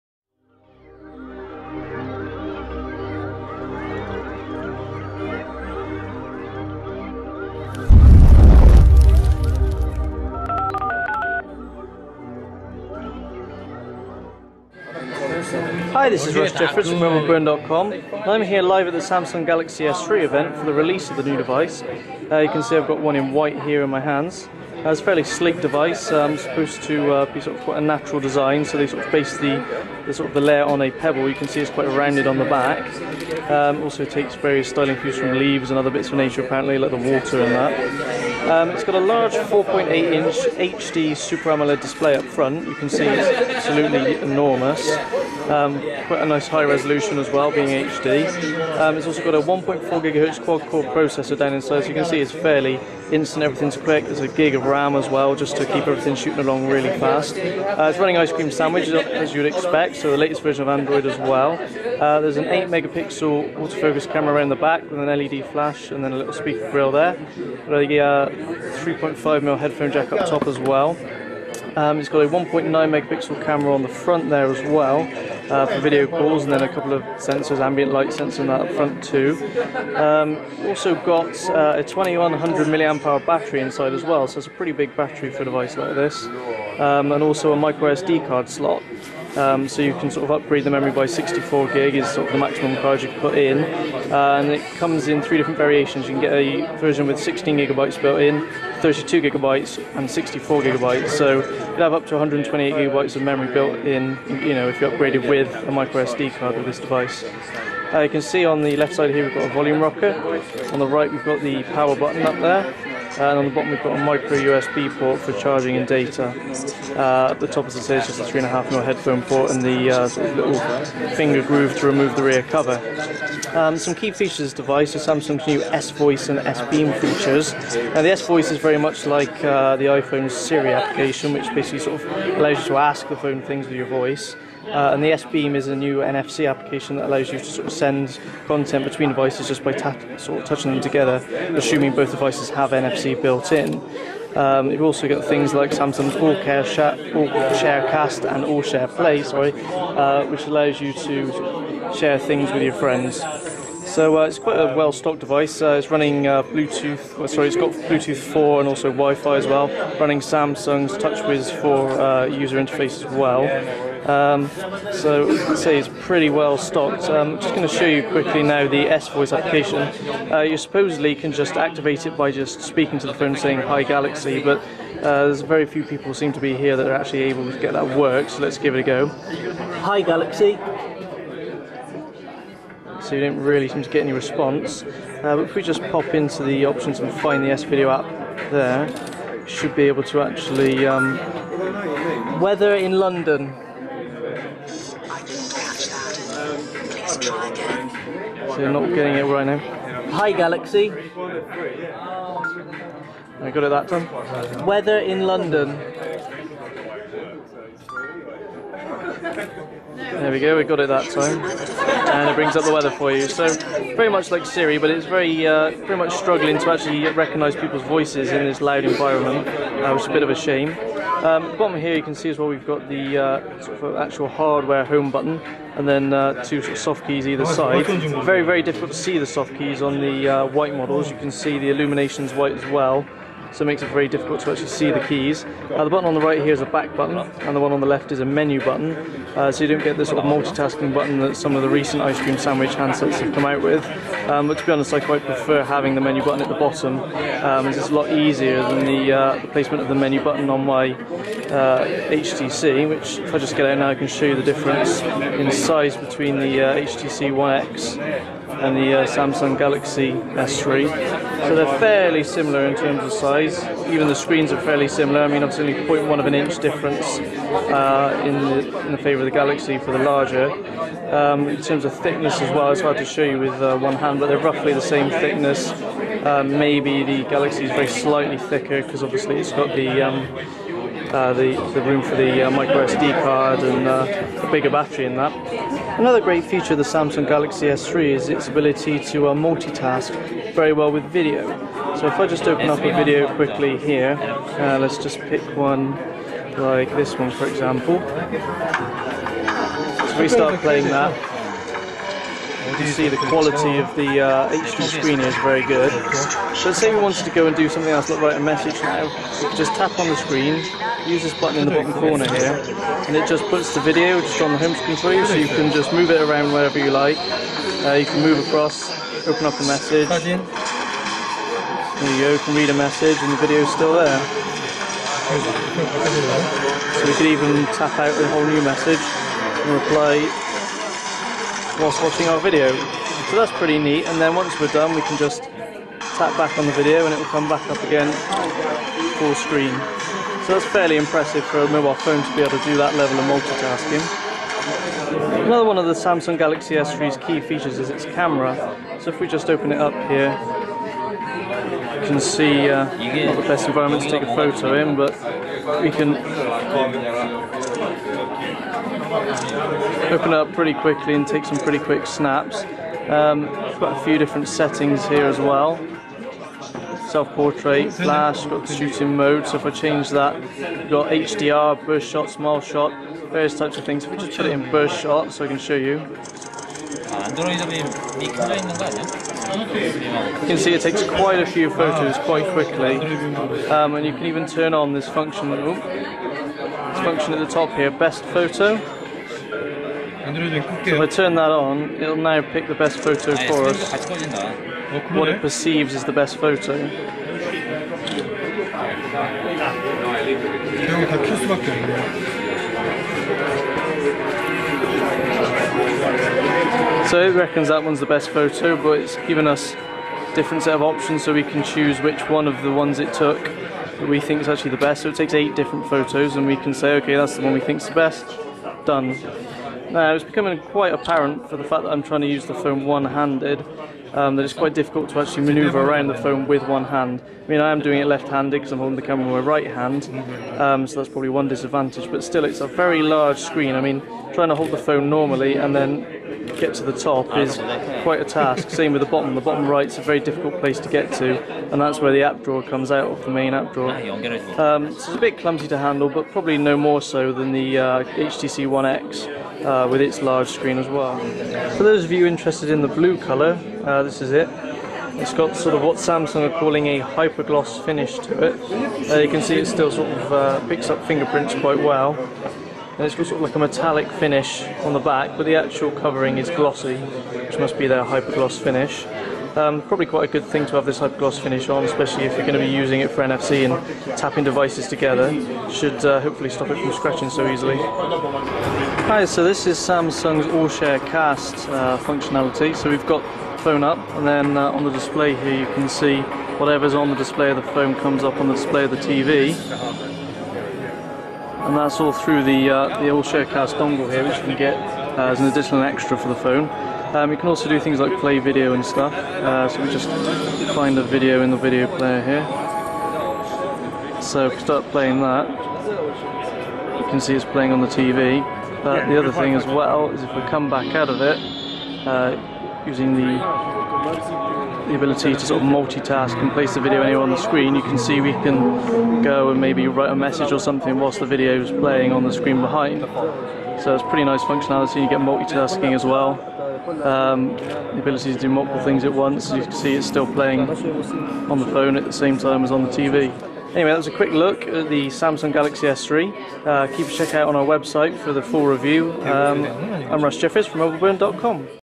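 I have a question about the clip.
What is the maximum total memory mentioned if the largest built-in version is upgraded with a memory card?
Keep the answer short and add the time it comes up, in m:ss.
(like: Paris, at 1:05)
128 gigabytes, at 1:42.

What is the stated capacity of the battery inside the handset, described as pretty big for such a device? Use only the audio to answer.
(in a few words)
2100 milliamp hour.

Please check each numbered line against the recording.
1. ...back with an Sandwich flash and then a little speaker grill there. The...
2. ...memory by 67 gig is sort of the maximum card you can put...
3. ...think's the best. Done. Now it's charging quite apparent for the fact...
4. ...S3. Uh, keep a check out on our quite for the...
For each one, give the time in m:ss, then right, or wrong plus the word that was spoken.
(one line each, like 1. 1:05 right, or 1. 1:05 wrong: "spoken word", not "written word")
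1. 1:04 wrong: "LED", not "Sandwich"
2. 1:30 wrong: "64", not "67"
3. 6:57 wrong: "becoming", not "charging"
4. 8:55 wrong: "website", not "quite".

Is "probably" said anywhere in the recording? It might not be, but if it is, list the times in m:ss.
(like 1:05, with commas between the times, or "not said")
7:11, 7:26, 7:49.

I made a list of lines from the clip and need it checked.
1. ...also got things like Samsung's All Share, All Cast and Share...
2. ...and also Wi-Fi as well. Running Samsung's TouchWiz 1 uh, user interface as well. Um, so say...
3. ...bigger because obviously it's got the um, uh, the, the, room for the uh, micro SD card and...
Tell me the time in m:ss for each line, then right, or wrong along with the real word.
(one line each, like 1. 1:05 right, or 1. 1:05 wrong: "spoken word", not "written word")
1. 2:24 right
2. 2:38 wrong: "4", not "1"
3. 4:38 wrong: "thicker", not "bigger".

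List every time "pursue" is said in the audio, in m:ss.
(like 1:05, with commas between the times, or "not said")
not said.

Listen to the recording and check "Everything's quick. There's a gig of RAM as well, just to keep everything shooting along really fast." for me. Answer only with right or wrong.
right.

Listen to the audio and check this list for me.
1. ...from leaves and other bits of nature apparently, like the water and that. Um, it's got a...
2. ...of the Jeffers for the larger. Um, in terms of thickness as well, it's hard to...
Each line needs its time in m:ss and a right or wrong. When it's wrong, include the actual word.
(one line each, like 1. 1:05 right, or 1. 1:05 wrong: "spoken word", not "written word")
1. 0:35 right
2. 4:29 wrong: "Galaxy", not "Jeffers".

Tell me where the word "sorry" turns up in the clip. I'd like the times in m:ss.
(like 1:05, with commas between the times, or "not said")
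2:29, 2:37.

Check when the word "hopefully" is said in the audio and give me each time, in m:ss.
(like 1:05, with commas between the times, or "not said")
7:56.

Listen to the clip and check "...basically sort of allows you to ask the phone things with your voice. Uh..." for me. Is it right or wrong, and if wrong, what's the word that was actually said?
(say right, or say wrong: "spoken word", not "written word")
right.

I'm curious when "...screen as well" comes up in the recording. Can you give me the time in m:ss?
7:30.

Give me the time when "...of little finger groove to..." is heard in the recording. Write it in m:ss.
2:00.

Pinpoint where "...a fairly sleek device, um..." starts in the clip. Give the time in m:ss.
0:24.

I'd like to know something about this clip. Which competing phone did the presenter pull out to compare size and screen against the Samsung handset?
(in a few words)
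HTC One X.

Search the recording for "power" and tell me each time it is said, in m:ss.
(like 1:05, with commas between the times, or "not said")
1:51.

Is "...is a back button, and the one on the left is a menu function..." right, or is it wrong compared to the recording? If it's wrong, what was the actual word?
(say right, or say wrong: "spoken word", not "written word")
wrong: "button", not "function".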